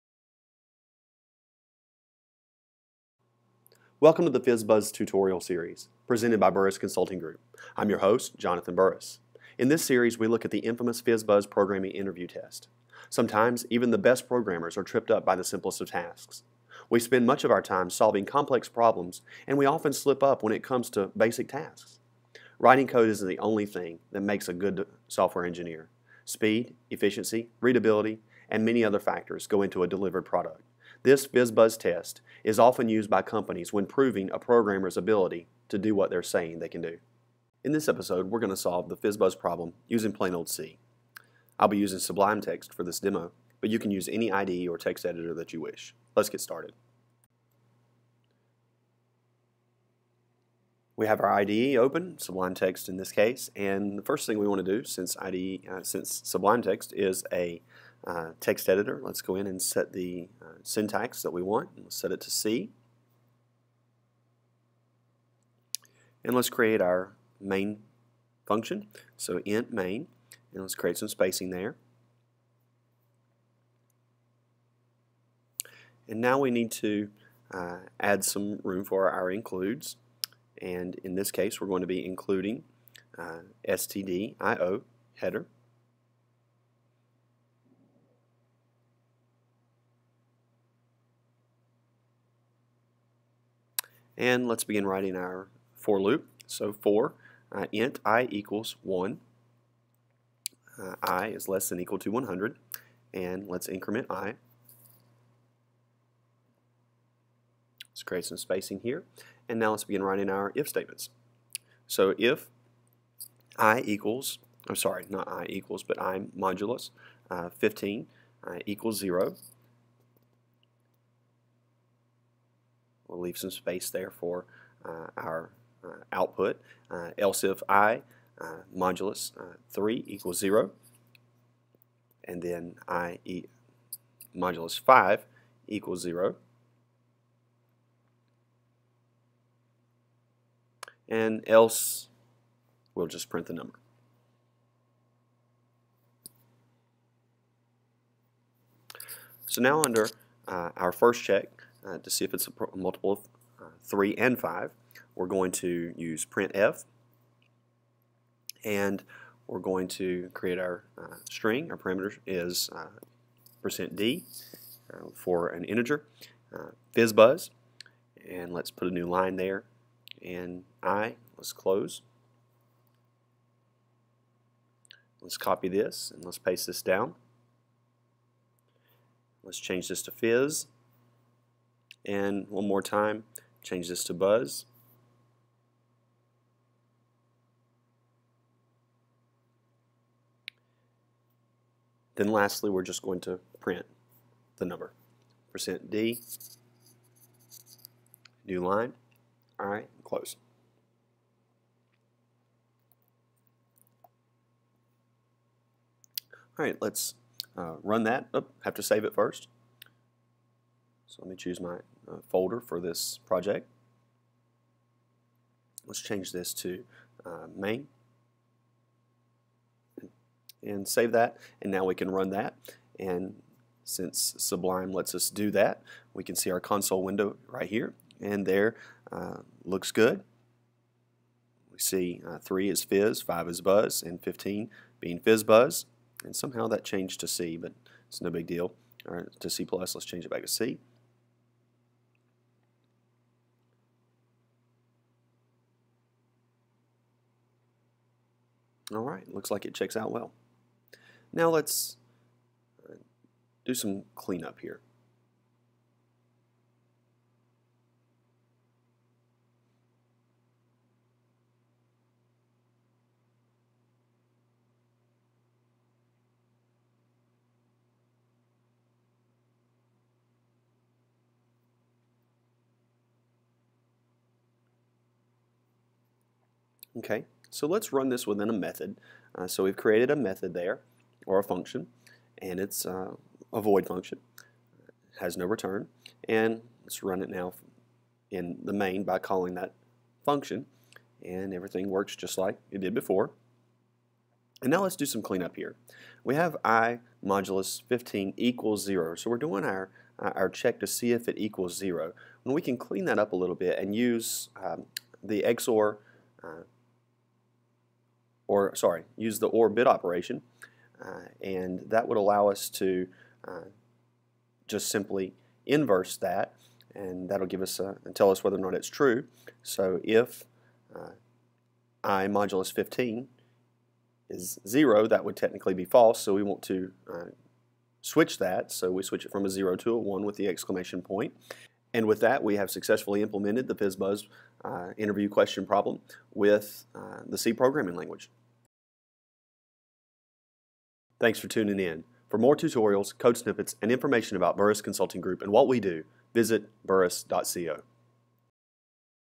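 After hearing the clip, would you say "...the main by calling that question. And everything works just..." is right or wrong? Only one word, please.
wrong.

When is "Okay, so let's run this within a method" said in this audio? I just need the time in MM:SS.
04:36.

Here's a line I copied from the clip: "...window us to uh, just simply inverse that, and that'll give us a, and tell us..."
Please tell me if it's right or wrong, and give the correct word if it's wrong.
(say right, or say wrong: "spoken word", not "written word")
wrong: "allow", not "window".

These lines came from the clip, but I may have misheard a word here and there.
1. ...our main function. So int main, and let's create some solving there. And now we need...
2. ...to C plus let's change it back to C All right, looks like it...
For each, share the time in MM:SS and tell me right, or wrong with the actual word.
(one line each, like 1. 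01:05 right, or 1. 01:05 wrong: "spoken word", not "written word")
1. 01:06 wrong: "spacing", not "solving"
2. 03:59 right.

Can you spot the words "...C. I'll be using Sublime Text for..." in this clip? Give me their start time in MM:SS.
00:40.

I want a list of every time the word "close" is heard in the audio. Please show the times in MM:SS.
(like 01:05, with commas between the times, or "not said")
02:51, 03:20.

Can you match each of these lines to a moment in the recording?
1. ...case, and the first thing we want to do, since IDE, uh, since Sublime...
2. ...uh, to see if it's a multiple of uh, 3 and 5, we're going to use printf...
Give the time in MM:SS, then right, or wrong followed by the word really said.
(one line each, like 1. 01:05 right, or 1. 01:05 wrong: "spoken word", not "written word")
1. 00:53 right
2. 02:31 right.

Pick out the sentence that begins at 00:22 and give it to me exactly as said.
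Writing code isn't the only thing that makes a good software engineer.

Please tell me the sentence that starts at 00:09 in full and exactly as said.
In this series, we look at the infamous FizzBuzz programming interview test.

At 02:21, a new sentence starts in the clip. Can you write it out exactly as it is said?
And else, we'll just print the number.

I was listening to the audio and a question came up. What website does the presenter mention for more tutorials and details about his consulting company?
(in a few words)
burris.co.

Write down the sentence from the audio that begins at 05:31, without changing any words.
And with that, we have successfully implemented the FizzBuzz uh, interview question problem with uh, the C programming language.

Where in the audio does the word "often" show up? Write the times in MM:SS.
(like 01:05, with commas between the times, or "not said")
00:19, 00:32.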